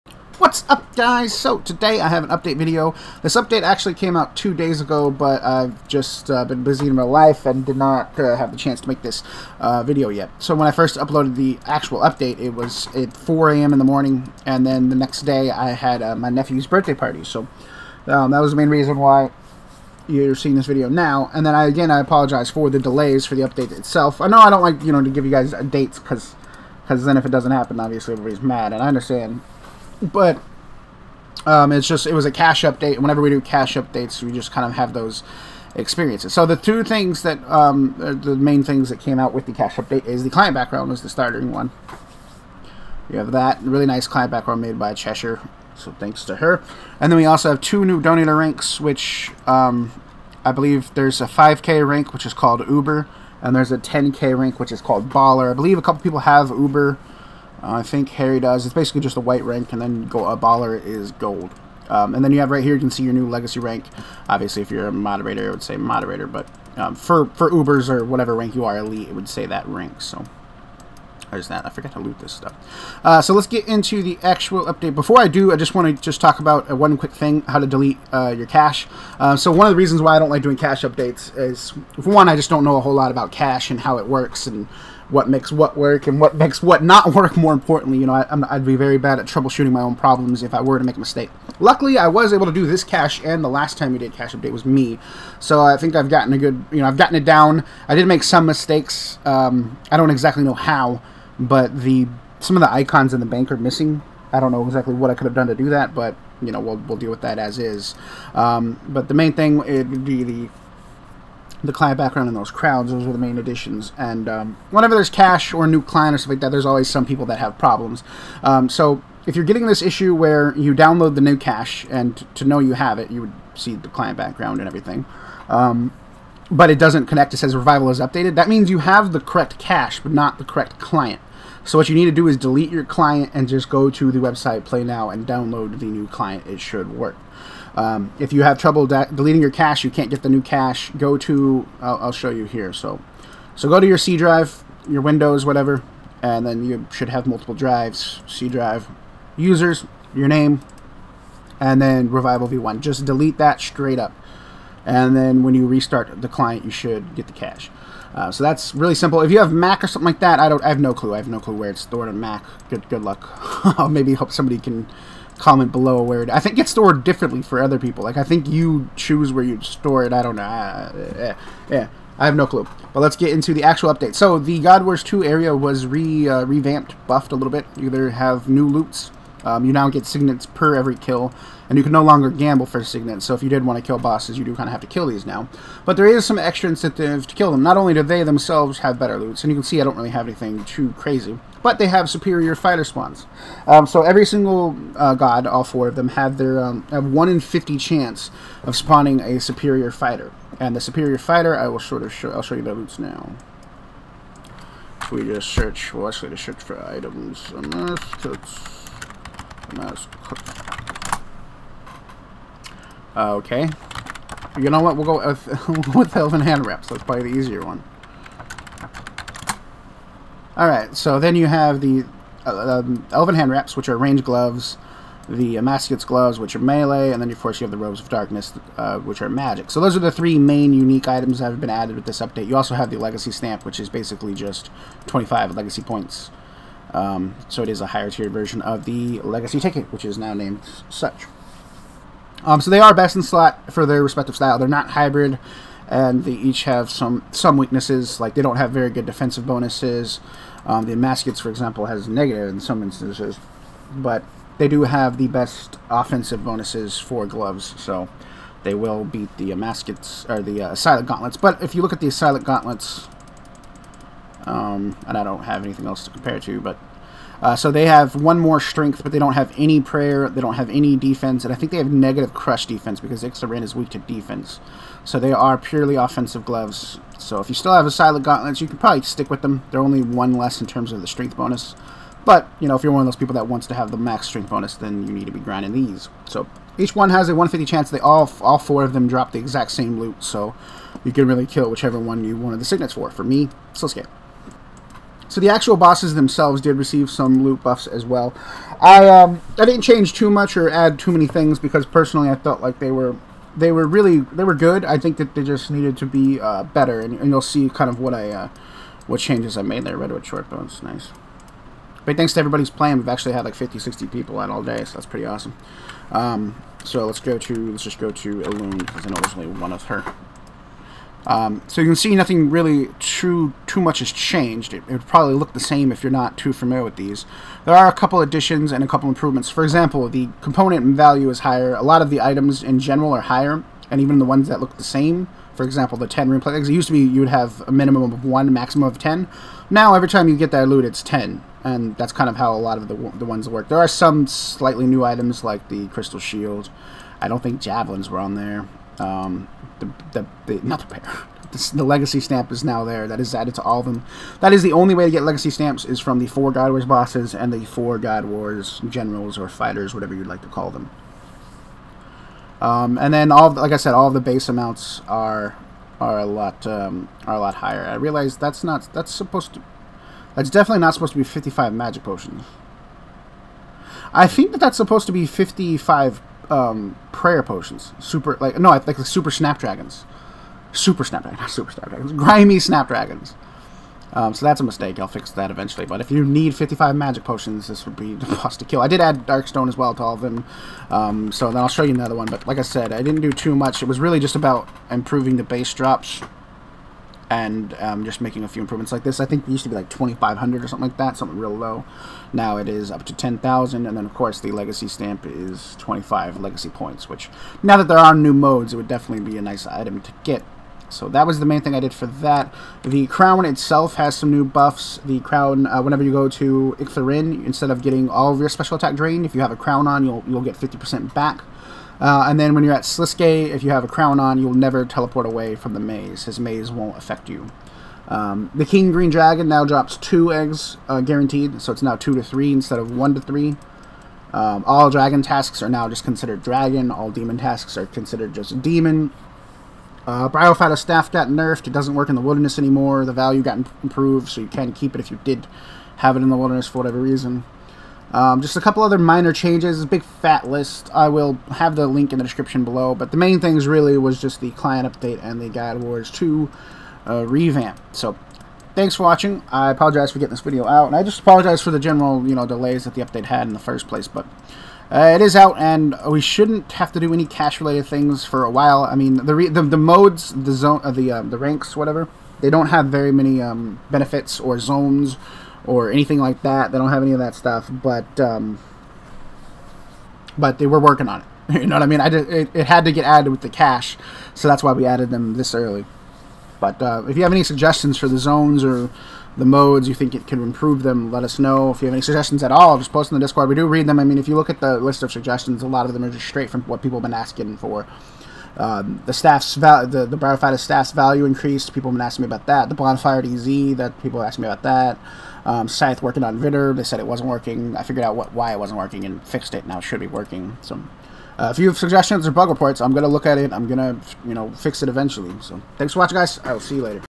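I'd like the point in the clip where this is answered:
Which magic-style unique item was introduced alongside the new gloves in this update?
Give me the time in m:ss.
3:47.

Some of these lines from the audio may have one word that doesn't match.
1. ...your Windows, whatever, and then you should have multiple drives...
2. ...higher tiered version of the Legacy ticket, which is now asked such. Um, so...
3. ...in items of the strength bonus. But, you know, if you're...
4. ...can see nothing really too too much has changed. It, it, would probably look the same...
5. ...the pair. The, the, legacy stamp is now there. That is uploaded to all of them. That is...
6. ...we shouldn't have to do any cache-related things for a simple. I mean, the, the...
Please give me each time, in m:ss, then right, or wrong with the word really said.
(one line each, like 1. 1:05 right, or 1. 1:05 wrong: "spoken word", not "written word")
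1. 2:24 right
2. 3:57 wrong: "named", not "asked"
3. 4:40 wrong: "terms", not "items"
4. 5:21 right
5. 5:50 wrong: "added", not "uploaded"
6. 7:46 wrong: "while", not "simple".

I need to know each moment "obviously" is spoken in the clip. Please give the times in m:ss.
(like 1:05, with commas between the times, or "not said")
0:27, 1:04.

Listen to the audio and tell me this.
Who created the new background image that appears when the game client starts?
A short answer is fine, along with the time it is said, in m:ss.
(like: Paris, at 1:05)
Cheshire, at 0:44.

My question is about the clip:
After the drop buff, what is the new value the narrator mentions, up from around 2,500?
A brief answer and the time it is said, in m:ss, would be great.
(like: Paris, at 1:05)
10,000, at 6:43.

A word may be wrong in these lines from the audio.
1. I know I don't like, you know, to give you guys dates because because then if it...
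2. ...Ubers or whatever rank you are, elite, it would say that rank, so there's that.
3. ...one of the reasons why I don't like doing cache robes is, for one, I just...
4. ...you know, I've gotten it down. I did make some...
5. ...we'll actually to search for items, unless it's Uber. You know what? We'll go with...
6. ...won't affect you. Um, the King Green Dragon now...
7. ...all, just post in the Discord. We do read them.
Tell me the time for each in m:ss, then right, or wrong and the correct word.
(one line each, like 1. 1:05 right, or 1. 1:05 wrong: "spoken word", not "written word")
1. 0:24 right
2. 1:07 right
3. 1:19 wrong: "updates", not "robes"
4. 1:36 right
5. 3:25 wrong: "Okay", not "Uber"
6. 7:06 right
7. 8:12 right.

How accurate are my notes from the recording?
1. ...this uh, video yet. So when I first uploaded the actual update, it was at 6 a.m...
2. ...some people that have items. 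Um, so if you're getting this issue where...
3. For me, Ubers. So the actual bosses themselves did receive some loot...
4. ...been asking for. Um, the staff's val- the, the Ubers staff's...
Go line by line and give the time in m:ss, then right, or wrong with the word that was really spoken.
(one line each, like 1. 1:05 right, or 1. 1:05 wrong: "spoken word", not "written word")
1. 0:09 wrong: "4", not "6"
2. 1:56 wrong: "problems", not "items"
3. 4:53 wrong: "Sliske", not "Ubers"
4. 8:17 wrong: "Bryophyta", not "Ubers".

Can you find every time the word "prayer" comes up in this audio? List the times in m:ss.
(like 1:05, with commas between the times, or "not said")
4:29, 6:17.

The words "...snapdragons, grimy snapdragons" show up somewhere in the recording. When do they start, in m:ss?
6:21.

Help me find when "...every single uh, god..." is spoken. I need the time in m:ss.
3:14.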